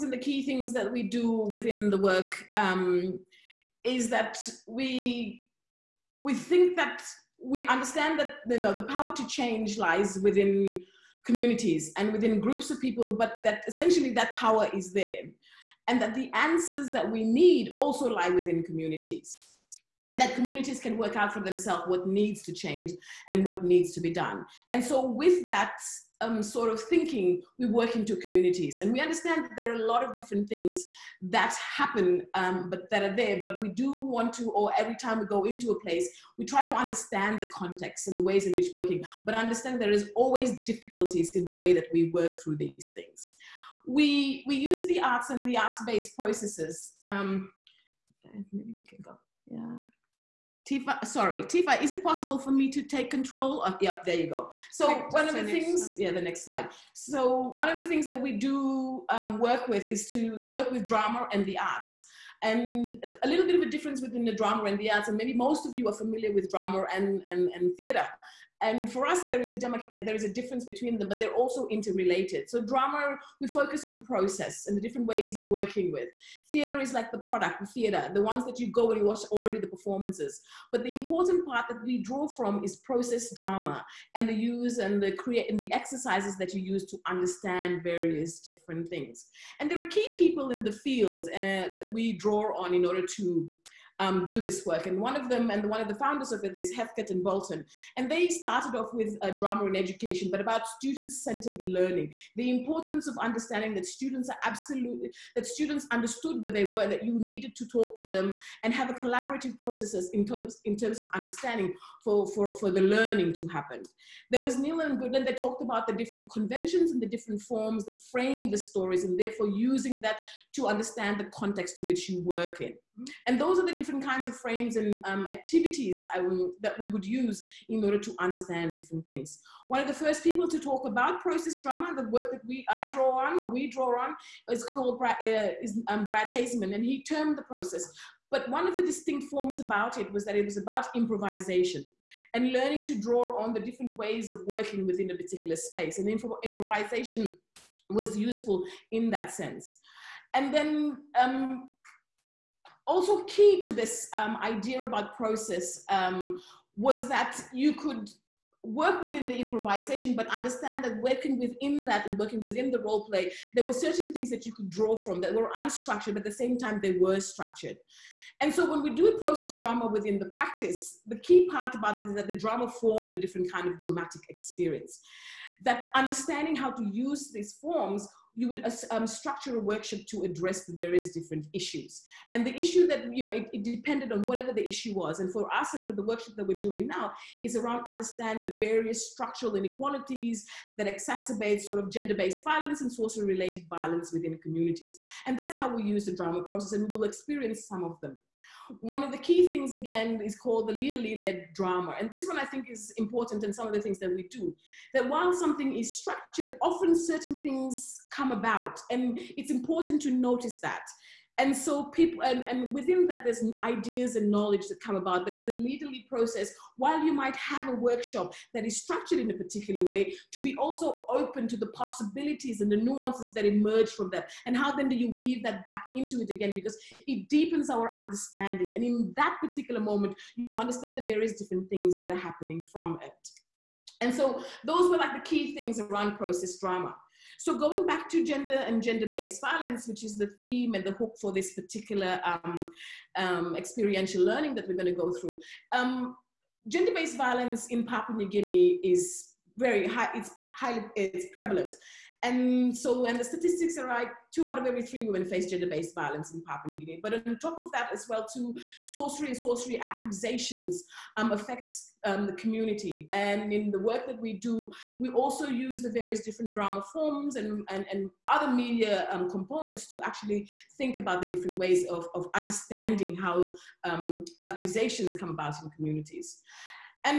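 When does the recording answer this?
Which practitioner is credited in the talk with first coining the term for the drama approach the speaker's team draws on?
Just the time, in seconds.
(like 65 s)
136 s.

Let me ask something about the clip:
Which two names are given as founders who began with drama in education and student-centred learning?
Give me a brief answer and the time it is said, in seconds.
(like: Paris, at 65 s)
Heathcote and Bolton, at 96 s.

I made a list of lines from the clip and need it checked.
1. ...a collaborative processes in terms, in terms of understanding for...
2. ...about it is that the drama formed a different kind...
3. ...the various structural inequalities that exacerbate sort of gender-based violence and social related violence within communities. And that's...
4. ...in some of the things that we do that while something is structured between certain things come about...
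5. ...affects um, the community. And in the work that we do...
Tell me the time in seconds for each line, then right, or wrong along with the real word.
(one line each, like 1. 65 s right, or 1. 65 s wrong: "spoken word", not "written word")
1. 108 s right
2. 171 s right
3. 188 s right
4. 203 s wrong: "often", not "between"
5. 261 s right.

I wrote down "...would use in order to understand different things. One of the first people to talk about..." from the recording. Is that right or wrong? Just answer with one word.
right.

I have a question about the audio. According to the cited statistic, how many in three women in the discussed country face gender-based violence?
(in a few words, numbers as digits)
2.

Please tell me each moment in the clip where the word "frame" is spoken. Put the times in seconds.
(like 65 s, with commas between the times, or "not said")
118 s, 124 s.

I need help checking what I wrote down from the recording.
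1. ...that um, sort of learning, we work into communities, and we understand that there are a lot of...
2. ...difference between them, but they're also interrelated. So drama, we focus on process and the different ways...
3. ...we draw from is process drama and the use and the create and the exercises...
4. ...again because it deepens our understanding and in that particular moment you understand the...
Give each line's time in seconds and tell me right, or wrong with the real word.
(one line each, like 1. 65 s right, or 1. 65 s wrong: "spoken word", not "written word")
1. 25 s wrong: "thinking", not "learning"
2. 70 s right
3. 81 s right
4. 226 s right.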